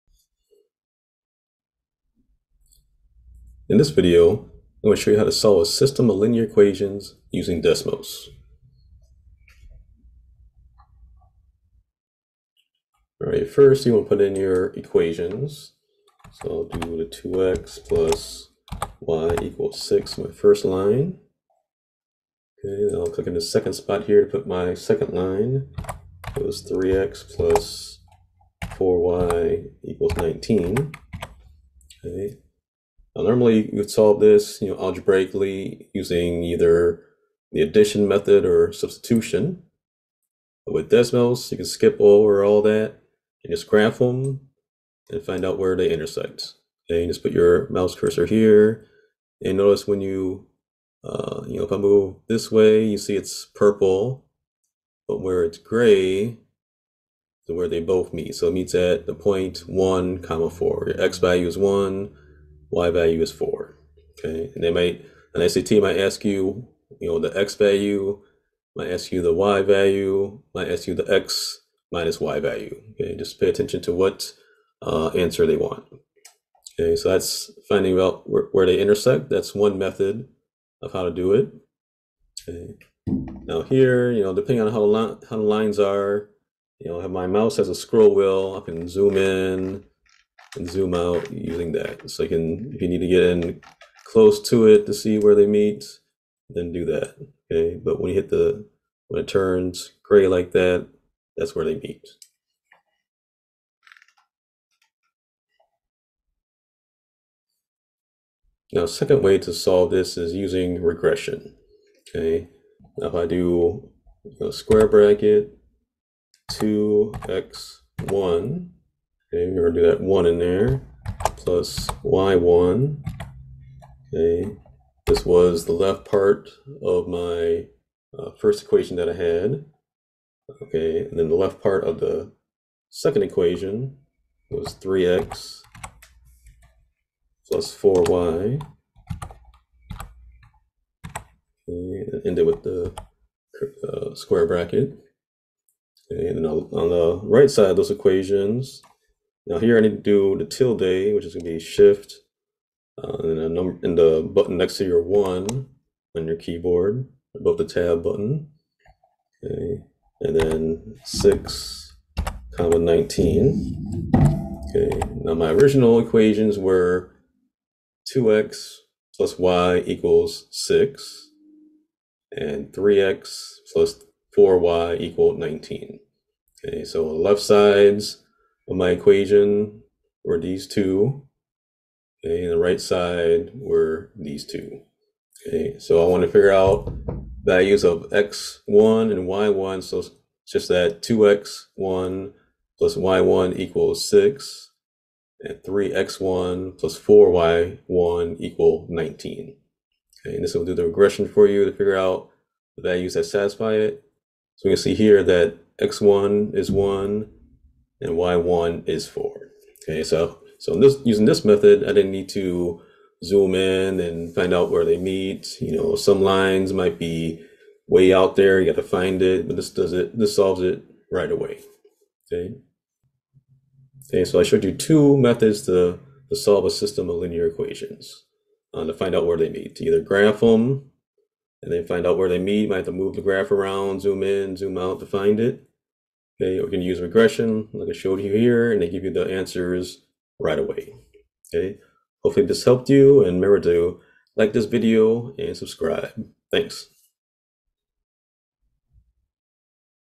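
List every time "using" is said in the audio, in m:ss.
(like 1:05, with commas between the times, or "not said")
0:07, 0:35, 1:31, 1:50, 3:31.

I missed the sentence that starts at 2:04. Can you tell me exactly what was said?
Okay, this was the left part of my uh, first equation that I had.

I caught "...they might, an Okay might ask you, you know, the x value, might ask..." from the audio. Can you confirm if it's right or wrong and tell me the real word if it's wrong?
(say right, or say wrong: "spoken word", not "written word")
wrong: "SAT", not "Okay".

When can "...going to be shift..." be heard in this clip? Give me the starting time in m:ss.
2:31.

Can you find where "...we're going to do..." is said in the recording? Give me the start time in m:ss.
1:59.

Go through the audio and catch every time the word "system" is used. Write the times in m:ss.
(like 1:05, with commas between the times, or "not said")
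0:05, 3:46.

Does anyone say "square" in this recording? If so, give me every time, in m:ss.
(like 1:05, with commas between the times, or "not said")
1:54, 2:24.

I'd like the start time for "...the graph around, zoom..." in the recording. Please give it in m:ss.
3:53.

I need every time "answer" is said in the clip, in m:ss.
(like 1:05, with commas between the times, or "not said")
1:15, 3:59.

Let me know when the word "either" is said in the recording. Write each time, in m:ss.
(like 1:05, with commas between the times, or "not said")
0:36, 3:49.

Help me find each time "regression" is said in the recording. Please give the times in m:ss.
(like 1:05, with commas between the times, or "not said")
1:50, 3:20, 3:57.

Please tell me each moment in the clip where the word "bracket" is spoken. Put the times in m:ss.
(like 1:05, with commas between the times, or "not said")
1:54, 2:24.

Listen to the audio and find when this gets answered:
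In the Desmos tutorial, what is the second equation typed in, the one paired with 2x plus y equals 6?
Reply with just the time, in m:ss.
0:26.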